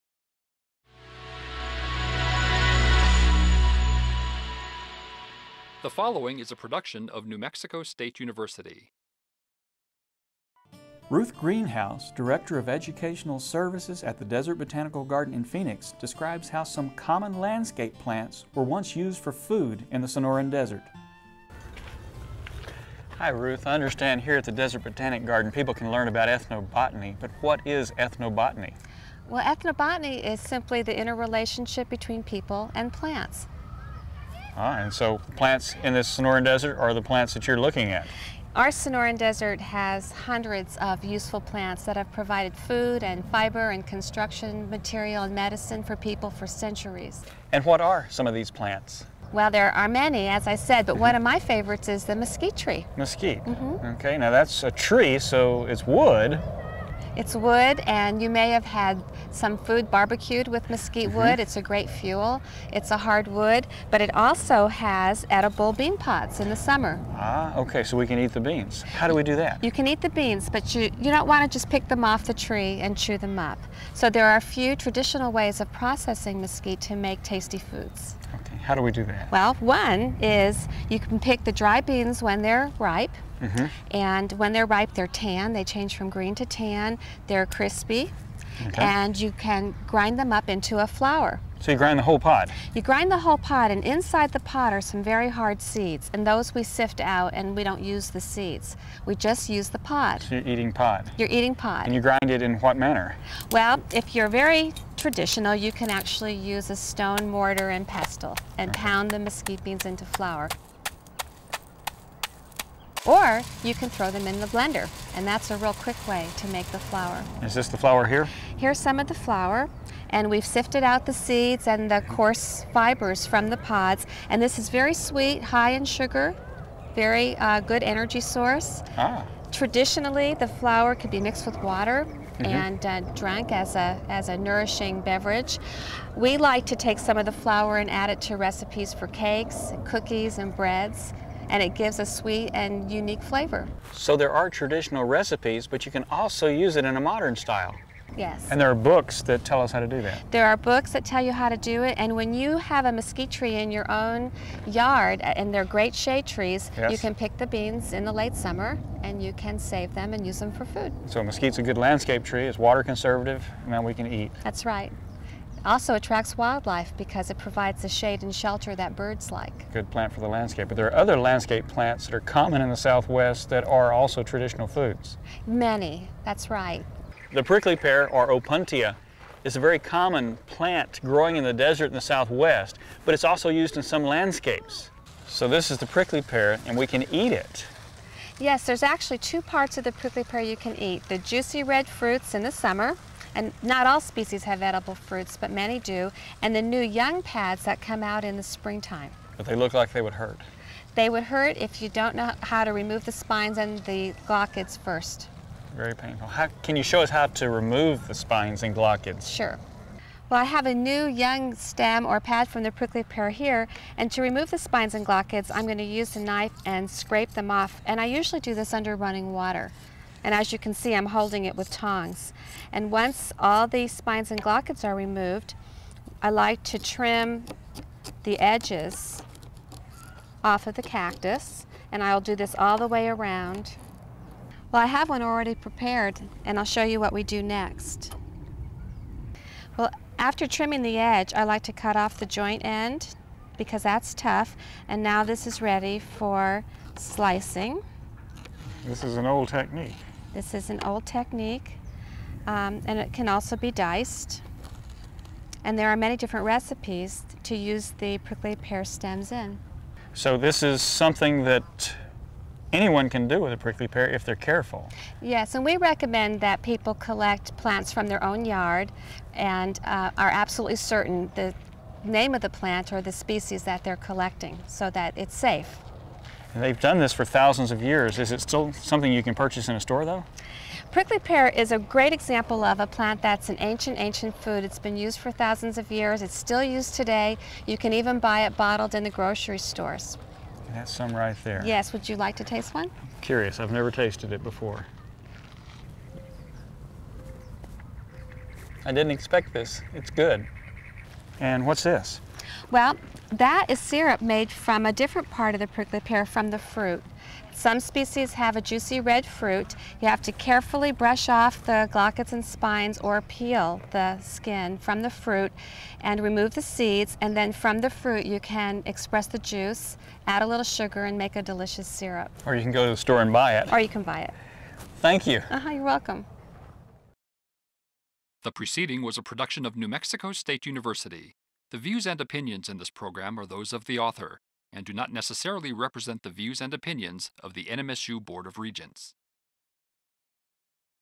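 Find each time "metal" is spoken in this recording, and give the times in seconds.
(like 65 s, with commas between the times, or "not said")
not said.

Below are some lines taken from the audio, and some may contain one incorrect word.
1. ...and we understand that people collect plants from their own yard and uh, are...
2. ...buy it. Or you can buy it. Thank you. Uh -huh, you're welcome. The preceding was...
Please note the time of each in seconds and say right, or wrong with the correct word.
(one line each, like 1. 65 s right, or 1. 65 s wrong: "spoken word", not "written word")
1. 265 s wrong: "recommend", not "understand"
2. 323 s right.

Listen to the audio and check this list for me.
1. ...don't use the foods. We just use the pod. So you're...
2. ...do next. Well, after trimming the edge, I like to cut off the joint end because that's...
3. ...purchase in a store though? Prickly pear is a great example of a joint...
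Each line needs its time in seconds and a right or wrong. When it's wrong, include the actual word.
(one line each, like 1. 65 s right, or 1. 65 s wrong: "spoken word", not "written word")
1. 97 s wrong: "seeds", not "foods"
2. 237 s right
3. 279 s wrong: "plant", not "joint".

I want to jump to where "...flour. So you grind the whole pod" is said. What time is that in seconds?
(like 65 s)
90 s.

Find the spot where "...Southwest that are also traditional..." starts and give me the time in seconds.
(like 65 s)
172 s.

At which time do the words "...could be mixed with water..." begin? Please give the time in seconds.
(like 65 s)
130 s.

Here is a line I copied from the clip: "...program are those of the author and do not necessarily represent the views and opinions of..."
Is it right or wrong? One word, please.
right.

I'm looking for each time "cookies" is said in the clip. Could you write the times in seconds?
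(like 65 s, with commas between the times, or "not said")
139 s.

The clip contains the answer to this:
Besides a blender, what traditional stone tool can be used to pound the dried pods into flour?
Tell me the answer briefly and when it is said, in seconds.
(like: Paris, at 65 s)
mortar and pestle, at 106 s.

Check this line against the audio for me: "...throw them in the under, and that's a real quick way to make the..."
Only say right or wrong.
wrong.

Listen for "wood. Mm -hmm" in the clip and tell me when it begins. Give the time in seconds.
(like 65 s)
61 s.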